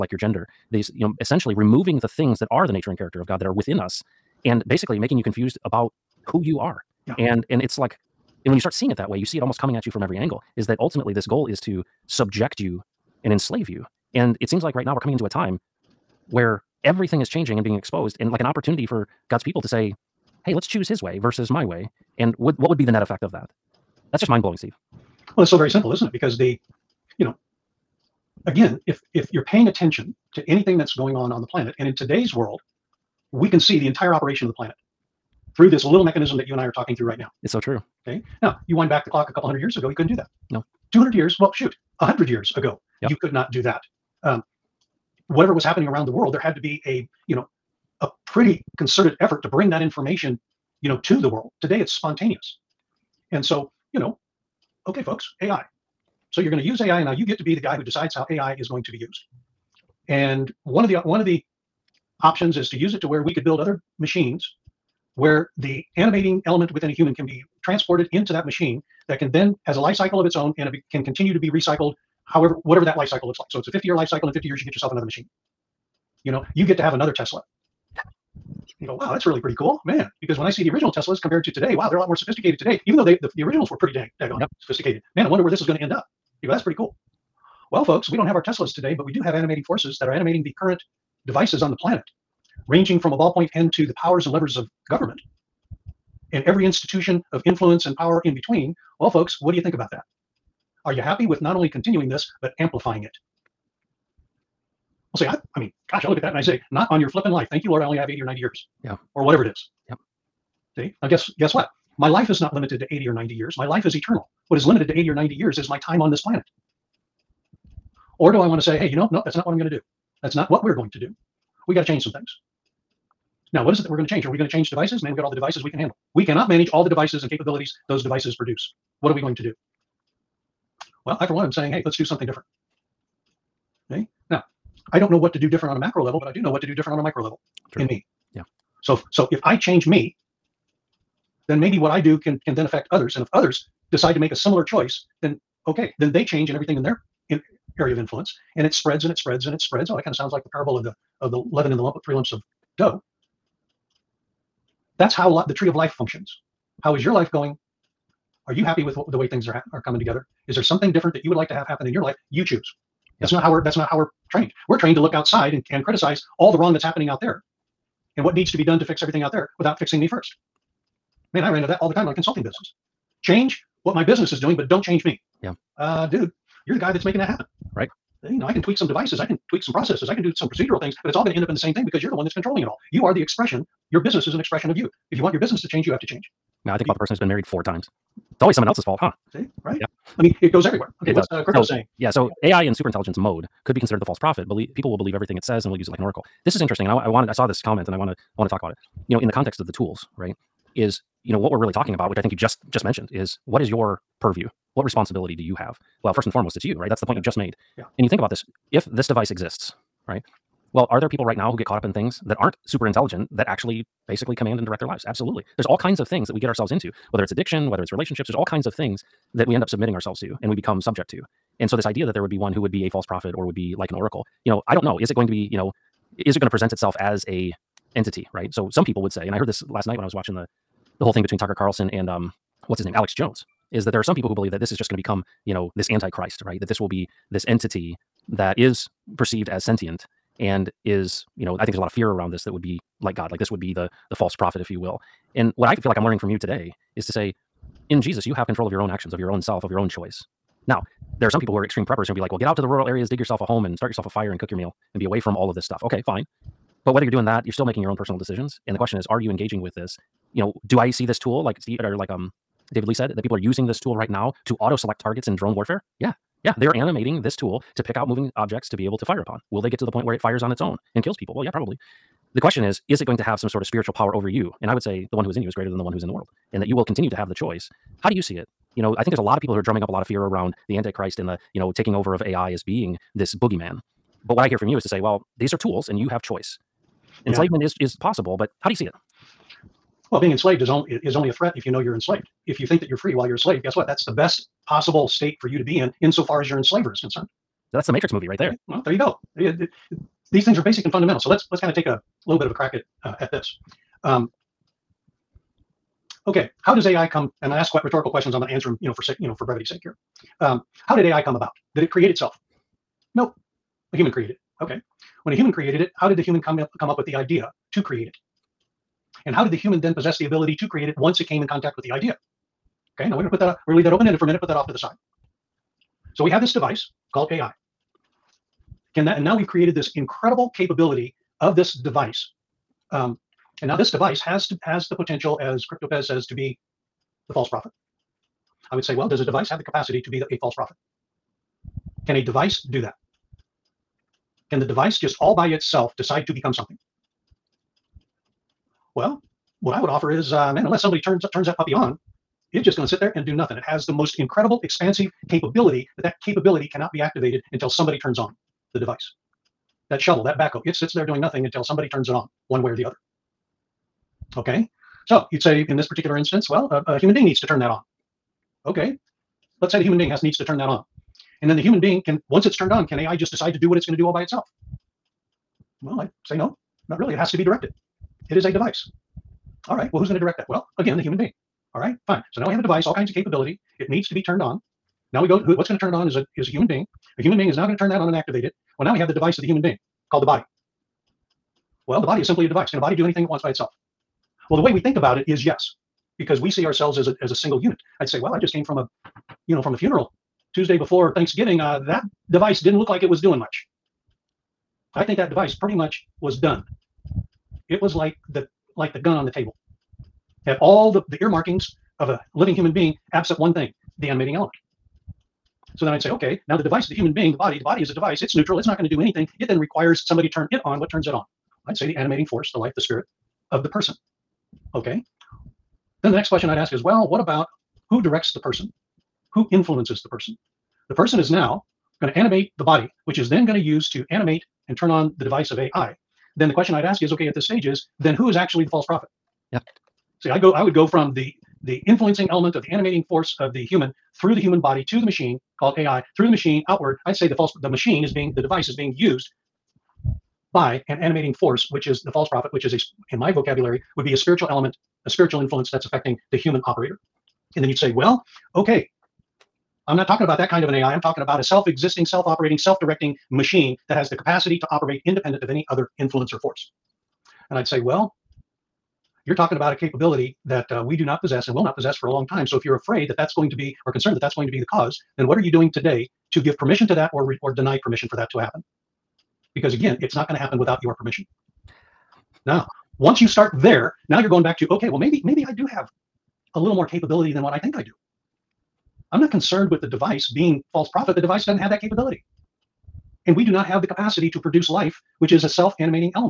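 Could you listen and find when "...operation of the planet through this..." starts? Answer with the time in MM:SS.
00:34.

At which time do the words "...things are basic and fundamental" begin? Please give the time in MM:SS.
05:00.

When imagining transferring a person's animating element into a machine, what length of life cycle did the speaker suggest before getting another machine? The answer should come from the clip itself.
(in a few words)
50 years.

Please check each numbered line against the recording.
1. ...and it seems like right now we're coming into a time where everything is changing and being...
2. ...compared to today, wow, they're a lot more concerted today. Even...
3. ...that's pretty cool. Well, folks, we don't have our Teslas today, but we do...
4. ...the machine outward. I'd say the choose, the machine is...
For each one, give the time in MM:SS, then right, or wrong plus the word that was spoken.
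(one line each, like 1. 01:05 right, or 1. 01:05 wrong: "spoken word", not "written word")
1. 00:14 right
2. 01:21 wrong: "sophisticated", not "concerted"
3. 01:26 right
4. 07:26 wrong: "false", not "choose".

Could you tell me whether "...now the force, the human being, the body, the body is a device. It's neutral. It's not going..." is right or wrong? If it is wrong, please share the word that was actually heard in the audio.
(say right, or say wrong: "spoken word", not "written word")
wrong: "device", not "force".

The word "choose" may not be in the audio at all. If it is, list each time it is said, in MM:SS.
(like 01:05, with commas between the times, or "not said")
00:20, 02:42.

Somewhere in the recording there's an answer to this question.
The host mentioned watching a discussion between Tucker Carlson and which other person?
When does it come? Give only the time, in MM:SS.
03:52.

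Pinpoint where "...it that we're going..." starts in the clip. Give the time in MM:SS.
02:03.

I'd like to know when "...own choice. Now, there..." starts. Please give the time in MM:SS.
04:09.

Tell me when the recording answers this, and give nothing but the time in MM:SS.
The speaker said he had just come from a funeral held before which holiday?
06:41.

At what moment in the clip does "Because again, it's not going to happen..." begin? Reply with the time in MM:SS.
07:59.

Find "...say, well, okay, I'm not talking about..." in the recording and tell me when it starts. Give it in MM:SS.
07:37.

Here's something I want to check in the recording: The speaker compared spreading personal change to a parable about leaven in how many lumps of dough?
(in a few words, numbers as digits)
3.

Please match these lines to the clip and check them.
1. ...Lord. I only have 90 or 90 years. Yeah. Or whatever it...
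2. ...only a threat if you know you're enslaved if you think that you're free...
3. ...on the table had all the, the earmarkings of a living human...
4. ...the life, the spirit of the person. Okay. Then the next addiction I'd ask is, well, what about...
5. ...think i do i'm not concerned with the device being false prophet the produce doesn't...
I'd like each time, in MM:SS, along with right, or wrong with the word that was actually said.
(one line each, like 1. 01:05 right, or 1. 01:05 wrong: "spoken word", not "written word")
1. 01:47 wrong: "80", not "90"
2. 04:51 right
3. 06:49 right
4. 07:02 wrong: "question", not "addiction"
5. 08:07 wrong: "device", not "produce".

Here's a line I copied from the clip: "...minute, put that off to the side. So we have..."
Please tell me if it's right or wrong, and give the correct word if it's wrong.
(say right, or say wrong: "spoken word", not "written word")
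right.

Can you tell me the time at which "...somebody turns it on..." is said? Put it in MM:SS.
06:01.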